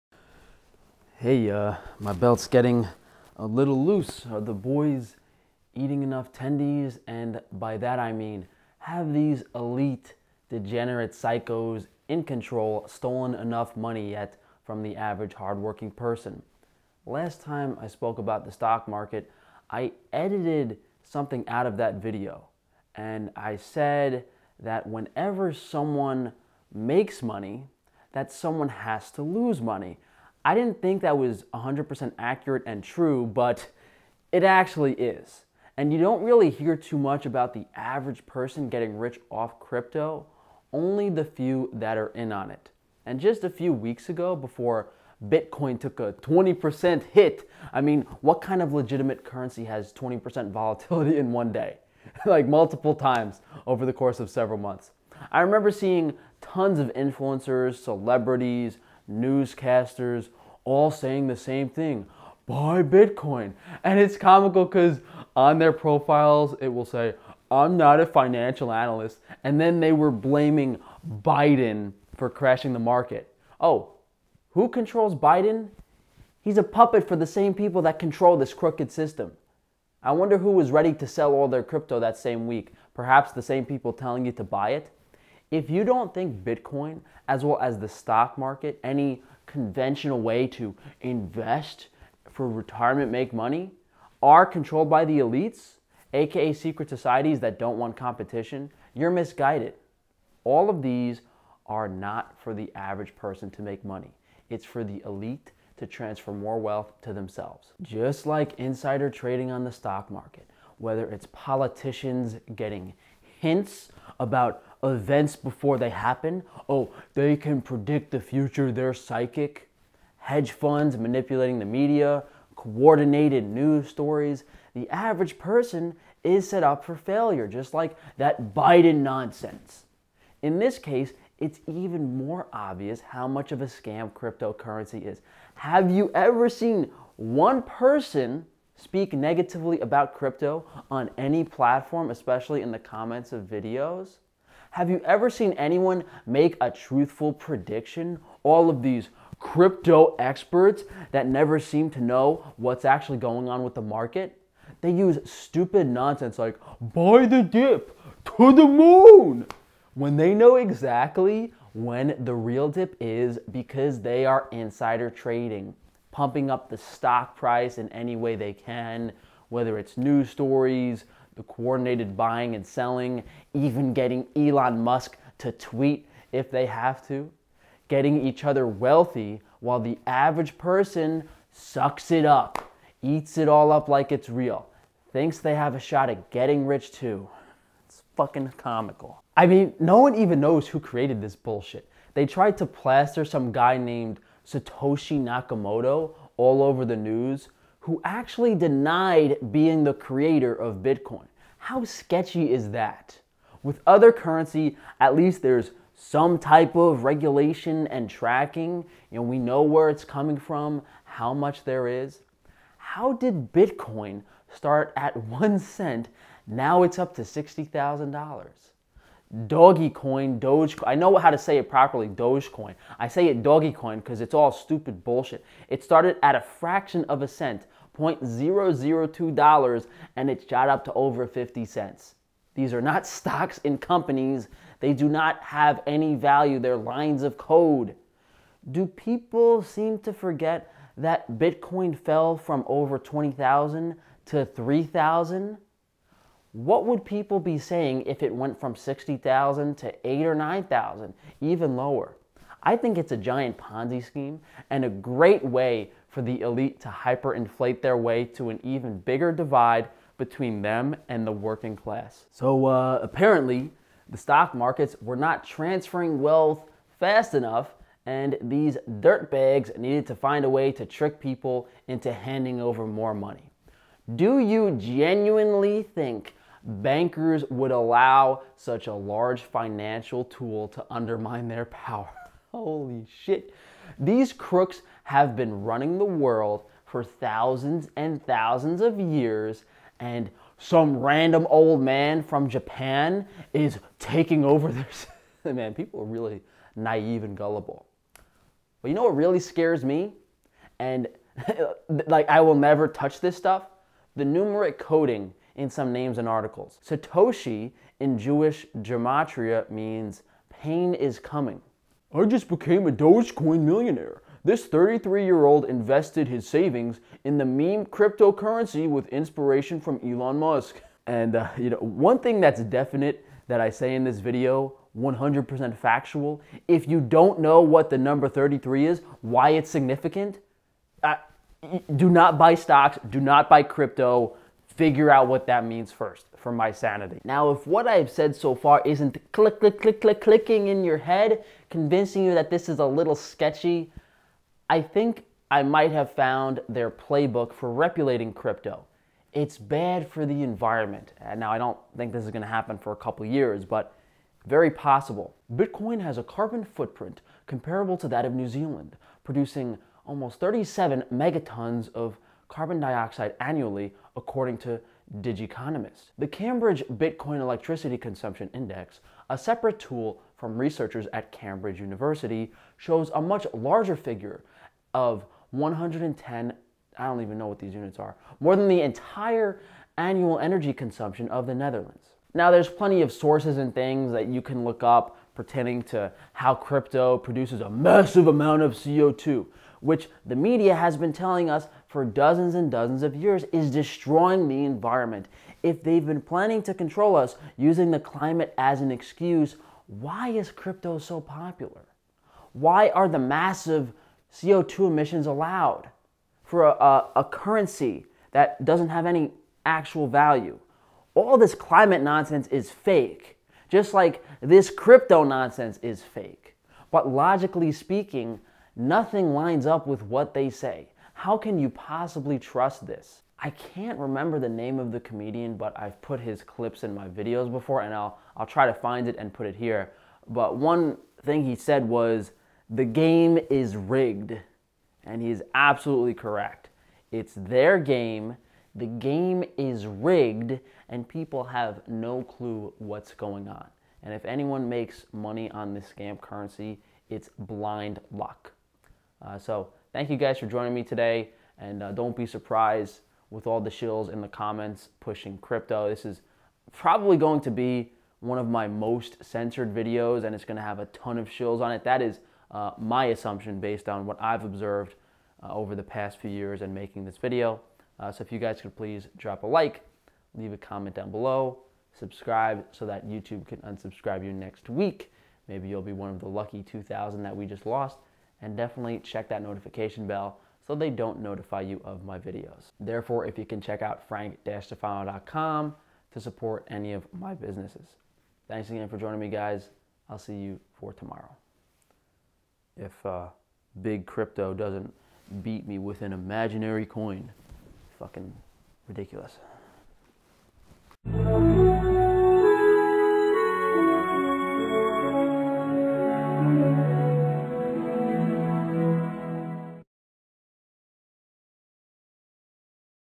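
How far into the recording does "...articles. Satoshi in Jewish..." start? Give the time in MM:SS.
05:06.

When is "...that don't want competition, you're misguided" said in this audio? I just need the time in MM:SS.
01:37.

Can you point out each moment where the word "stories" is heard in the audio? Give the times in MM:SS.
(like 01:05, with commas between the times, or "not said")
02:03, 02:50.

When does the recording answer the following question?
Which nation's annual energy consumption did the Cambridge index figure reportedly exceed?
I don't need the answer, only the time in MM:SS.
06:21.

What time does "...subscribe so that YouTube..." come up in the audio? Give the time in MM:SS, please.
07:51.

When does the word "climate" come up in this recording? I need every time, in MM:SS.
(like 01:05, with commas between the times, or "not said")
06:37, 06:51.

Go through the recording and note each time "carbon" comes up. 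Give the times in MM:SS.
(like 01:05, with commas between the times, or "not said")
05:56, 06:02.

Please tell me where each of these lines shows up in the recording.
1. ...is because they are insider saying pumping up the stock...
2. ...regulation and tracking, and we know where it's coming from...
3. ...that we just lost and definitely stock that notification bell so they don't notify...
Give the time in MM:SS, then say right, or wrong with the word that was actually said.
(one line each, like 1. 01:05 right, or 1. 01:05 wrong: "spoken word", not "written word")
1. 02:42 wrong: "trading", not "saying"
2. 03:27 right
3. 07:57 wrong: "check", not "stock".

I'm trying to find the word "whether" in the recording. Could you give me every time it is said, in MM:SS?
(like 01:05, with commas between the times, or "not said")
01:50, 02:49.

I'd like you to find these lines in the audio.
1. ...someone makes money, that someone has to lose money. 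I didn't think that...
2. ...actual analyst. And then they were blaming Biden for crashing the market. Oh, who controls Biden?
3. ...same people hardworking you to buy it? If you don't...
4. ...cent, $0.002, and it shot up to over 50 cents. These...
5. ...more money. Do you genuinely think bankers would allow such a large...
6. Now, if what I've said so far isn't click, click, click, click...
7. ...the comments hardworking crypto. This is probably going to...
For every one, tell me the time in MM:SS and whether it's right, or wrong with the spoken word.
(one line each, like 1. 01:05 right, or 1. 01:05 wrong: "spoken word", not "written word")
1. 00:25 right
2. 01:08 wrong: "financial", not "actual"
3. 01:23 wrong: "telling", not "hardworking"
4. 03:47 right
5. 04:32 right
6. 05:37 right
7. 07:34 wrong: "pushing", not "hardworking".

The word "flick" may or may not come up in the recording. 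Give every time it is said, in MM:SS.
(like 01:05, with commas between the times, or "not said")
not said.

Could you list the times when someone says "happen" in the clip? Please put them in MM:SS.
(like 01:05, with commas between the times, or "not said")
01:55, 05:52.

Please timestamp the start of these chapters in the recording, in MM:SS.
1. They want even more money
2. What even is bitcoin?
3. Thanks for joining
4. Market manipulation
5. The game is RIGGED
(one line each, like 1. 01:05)
1. 04:22
2. 03:09
3. 07:47
4. 01:48
5. 07:03.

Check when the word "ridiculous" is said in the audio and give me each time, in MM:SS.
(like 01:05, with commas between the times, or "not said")
08:18.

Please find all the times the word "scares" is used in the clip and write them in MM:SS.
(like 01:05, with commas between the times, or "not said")
04:59.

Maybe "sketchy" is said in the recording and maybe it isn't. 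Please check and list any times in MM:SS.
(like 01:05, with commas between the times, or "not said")
03:21, 05:43.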